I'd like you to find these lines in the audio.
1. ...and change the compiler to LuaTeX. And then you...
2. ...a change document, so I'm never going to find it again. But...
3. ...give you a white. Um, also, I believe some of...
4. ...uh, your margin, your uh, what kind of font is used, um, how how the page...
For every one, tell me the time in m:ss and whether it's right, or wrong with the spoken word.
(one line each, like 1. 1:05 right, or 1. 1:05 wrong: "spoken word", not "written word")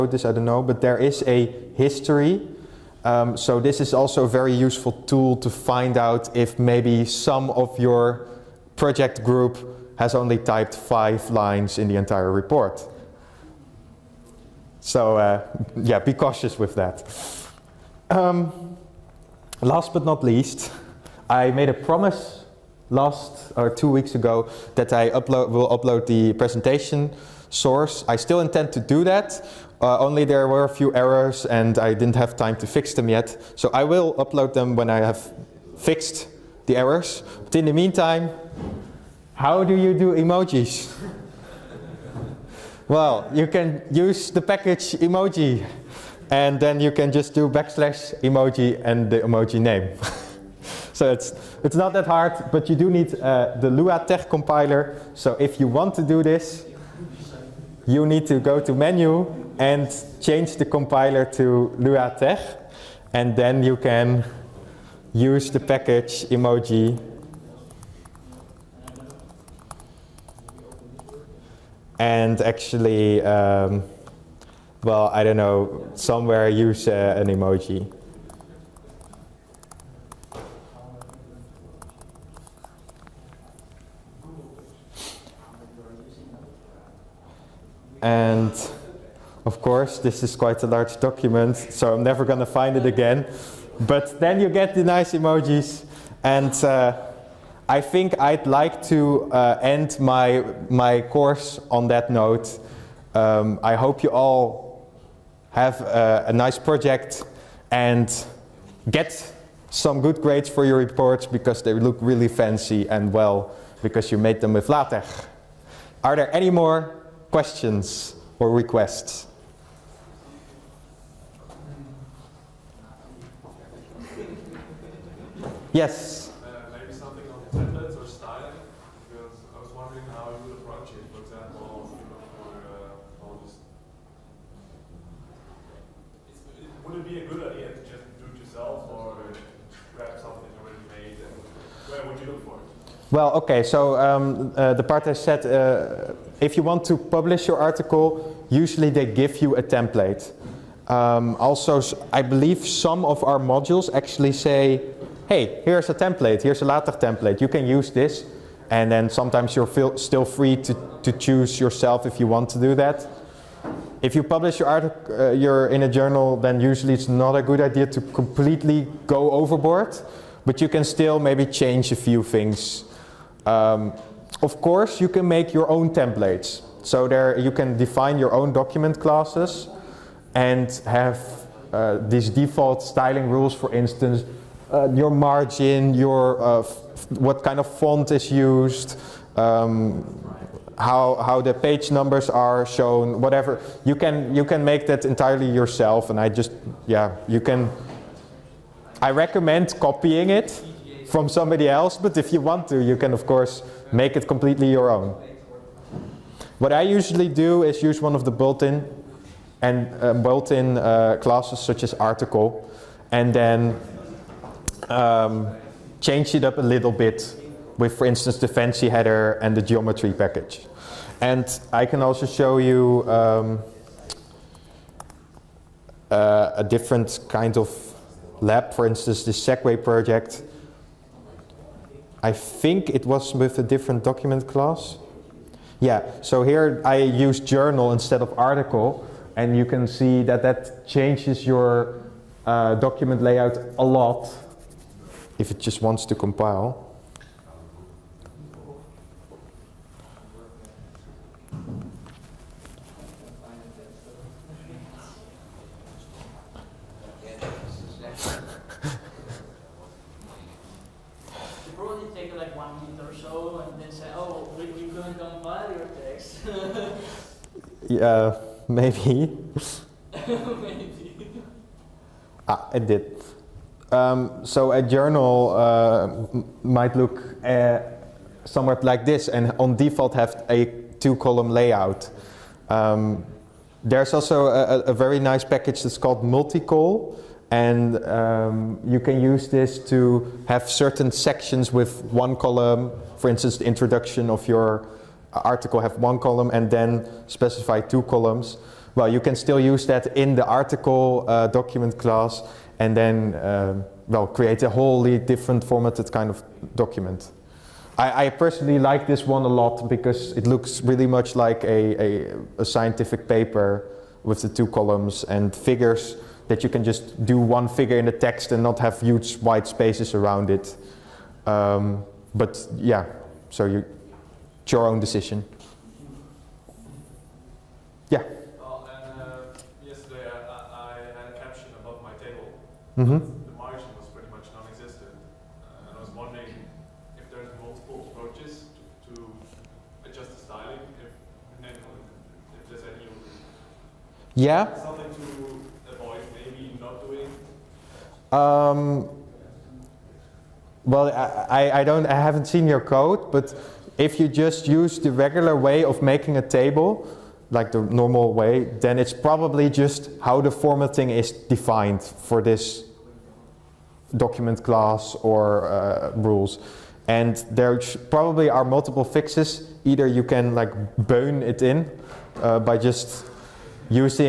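1. 0:59 right
2. 1:30 wrong: "large", not "change"
3. 2:29 wrong: "template", not "white"
4. 3:04 right.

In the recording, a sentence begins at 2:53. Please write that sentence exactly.
Um, of course, you can make your own templates.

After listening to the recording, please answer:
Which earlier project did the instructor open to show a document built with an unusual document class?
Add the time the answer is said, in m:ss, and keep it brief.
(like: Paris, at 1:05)
Segway project, at 3:49.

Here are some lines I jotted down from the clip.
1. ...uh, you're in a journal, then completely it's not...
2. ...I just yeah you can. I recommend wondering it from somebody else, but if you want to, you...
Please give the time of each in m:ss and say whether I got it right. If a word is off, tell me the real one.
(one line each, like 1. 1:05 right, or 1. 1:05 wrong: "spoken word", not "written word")
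1. 2:45 wrong: "usually", not "completely"
2. 3:16 wrong: "copying", not "wondering".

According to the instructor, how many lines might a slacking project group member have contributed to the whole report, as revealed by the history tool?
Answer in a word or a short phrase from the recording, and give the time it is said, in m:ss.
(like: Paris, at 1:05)
5, at 0:10.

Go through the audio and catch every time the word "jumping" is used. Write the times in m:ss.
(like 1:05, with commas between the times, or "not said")
not said.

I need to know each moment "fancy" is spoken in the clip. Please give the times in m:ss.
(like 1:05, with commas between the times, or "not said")
1:52, 3:38.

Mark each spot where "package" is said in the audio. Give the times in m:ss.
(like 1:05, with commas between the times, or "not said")
0:44, 1:05, 3:40, 4:45.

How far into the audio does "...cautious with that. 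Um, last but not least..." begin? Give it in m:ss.
0:16.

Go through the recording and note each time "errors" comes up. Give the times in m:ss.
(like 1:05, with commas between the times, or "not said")
0:30, 0:36.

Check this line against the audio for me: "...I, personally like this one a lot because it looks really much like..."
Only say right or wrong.
right.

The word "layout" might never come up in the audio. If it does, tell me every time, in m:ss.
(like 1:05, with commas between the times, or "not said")
4:03, 4:41.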